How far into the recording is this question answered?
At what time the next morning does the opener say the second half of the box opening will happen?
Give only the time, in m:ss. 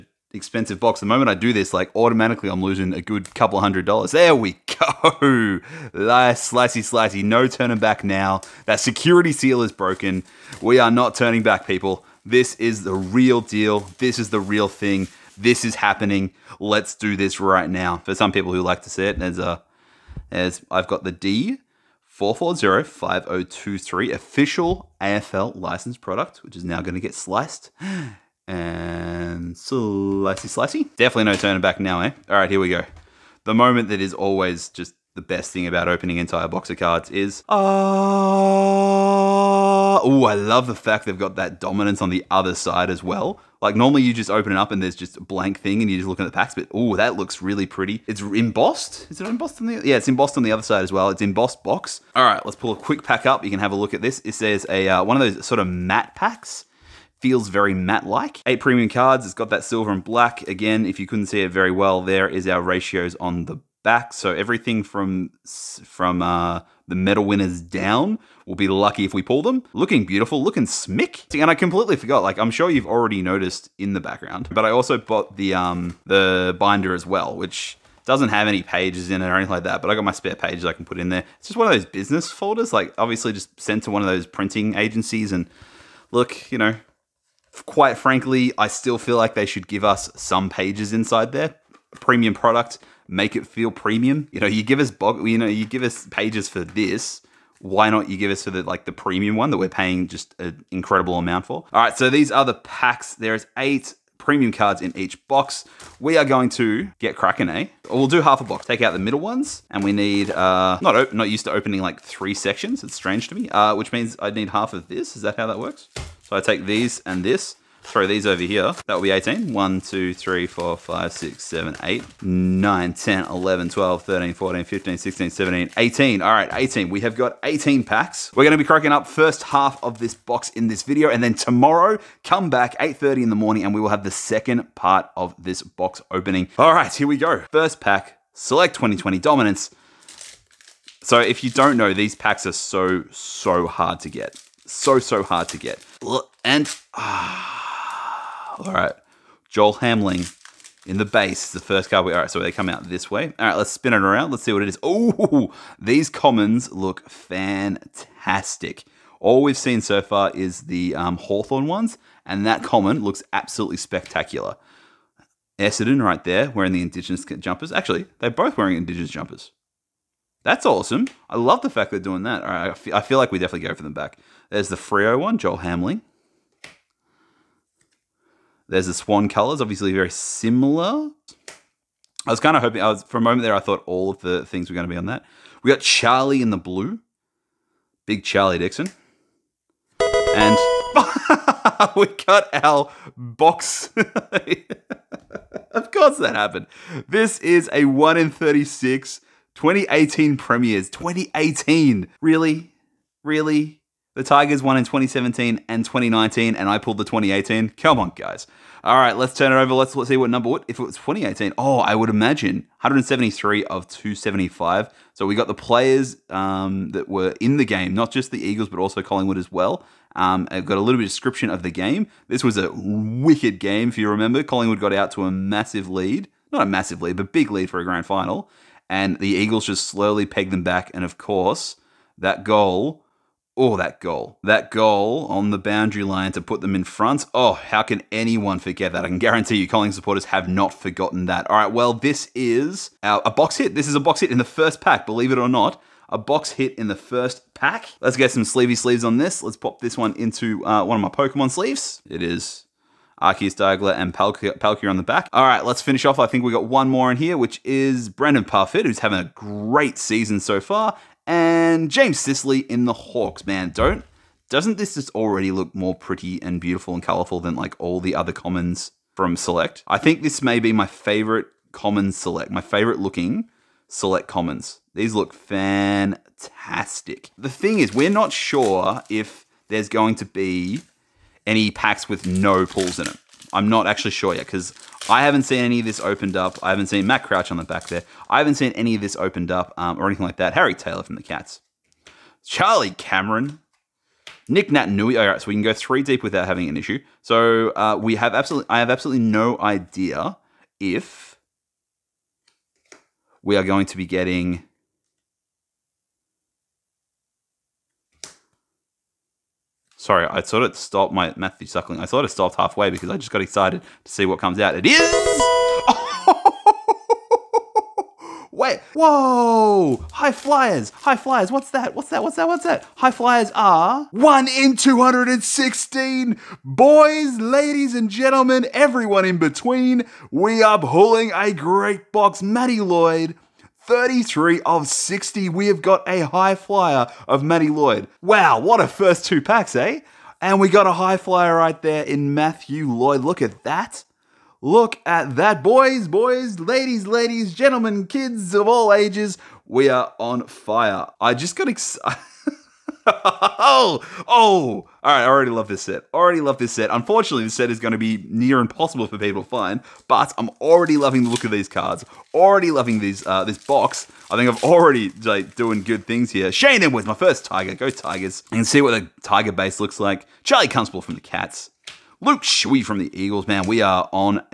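2:12.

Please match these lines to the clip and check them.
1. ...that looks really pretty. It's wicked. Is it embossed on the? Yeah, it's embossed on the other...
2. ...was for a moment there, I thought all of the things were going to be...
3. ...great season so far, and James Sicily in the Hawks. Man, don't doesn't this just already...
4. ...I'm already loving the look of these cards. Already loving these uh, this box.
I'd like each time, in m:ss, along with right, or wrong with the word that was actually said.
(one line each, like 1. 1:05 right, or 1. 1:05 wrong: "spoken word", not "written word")
1. 0:46 wrong: "embossed", not "wicked"
2. 3:02 right
3. 4:19 right
4. 6:00 right.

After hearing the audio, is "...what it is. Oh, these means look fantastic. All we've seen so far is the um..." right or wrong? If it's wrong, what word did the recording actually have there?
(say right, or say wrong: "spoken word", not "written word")
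wrong: "commons", not "means".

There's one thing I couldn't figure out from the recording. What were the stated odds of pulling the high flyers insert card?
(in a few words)
1 in 216.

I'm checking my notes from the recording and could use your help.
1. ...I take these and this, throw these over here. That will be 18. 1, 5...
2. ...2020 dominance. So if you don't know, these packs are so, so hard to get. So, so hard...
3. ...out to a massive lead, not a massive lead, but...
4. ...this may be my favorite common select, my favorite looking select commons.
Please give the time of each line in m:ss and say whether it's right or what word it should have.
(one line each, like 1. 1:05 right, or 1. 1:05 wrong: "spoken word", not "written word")
1. 1:56 wrong: "2", not "5"
2. 2:18 right
3. 3:44 right
4. 4:30 right.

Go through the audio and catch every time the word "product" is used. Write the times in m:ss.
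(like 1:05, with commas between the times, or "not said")
0:26, 1:32.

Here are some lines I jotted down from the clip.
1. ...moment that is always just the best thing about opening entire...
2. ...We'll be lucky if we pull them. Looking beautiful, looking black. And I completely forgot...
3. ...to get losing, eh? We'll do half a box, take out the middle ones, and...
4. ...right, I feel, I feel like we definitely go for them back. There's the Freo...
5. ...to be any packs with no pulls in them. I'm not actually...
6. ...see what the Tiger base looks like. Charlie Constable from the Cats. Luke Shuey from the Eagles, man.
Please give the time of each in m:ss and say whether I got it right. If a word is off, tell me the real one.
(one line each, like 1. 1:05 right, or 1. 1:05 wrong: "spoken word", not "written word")
1. 0:33 right
2. 1:08 wrong: "smick", not "black"
3. 1:46 wrong: "cracking", not "losing"
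4. 2:52 right
5. 4:40 right
6. 6:08 right.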